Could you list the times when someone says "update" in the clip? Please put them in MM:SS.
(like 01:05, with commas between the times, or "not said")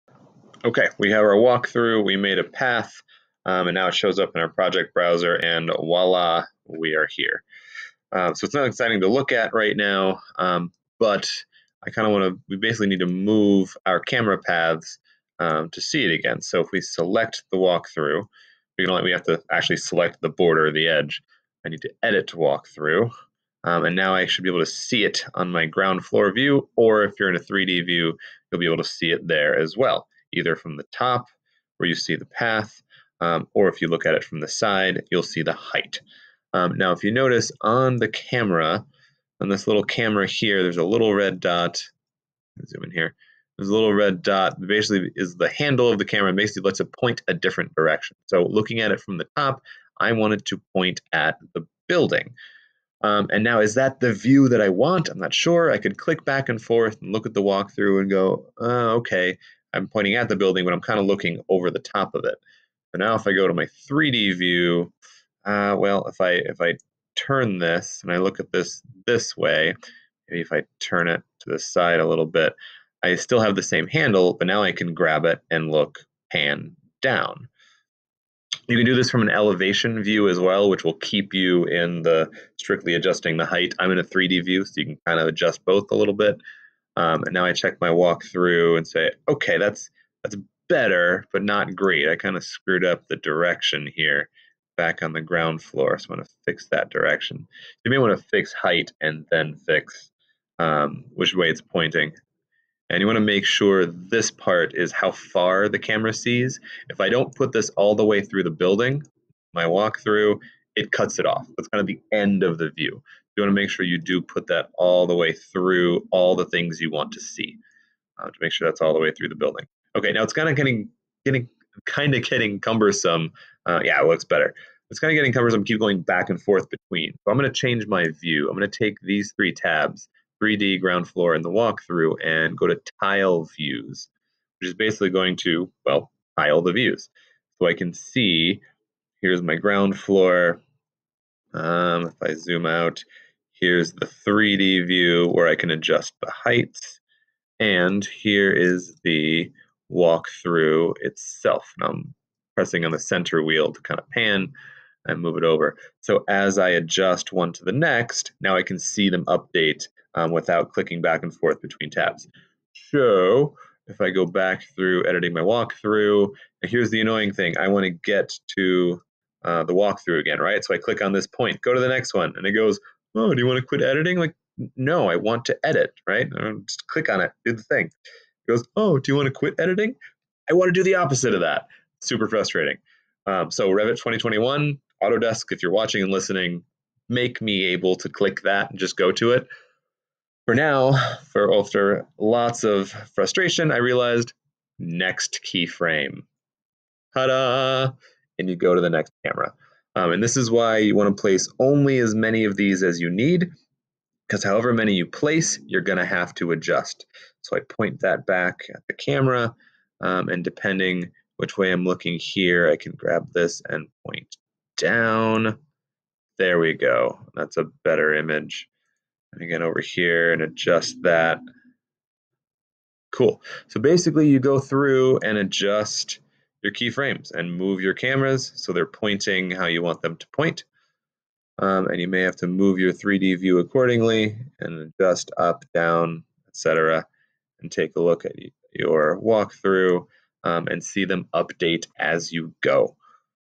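02:39, 04:01.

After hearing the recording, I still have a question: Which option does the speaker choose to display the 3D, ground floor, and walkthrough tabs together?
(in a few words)
Tile views.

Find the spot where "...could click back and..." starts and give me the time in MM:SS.
00:55.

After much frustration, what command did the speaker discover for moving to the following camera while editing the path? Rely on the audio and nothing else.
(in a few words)
Next keyframe.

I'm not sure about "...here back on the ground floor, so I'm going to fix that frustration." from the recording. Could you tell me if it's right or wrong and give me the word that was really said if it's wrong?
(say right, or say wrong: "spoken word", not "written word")
wrong: "direction", not "frustration".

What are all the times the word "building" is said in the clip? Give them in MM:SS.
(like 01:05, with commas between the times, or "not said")
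00:51, 01:00, 01:48, 01:59.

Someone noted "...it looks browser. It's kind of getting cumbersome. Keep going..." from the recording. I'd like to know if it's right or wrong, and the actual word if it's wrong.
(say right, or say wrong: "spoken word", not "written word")
wrong: "better", not "browser".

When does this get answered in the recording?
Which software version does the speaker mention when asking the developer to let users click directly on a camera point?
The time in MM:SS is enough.
03:03.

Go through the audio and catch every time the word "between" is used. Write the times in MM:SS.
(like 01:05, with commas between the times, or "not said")
02:06, 02:41.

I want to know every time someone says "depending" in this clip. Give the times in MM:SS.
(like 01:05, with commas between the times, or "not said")
03:30.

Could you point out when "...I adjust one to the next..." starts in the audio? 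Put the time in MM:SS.
02:36.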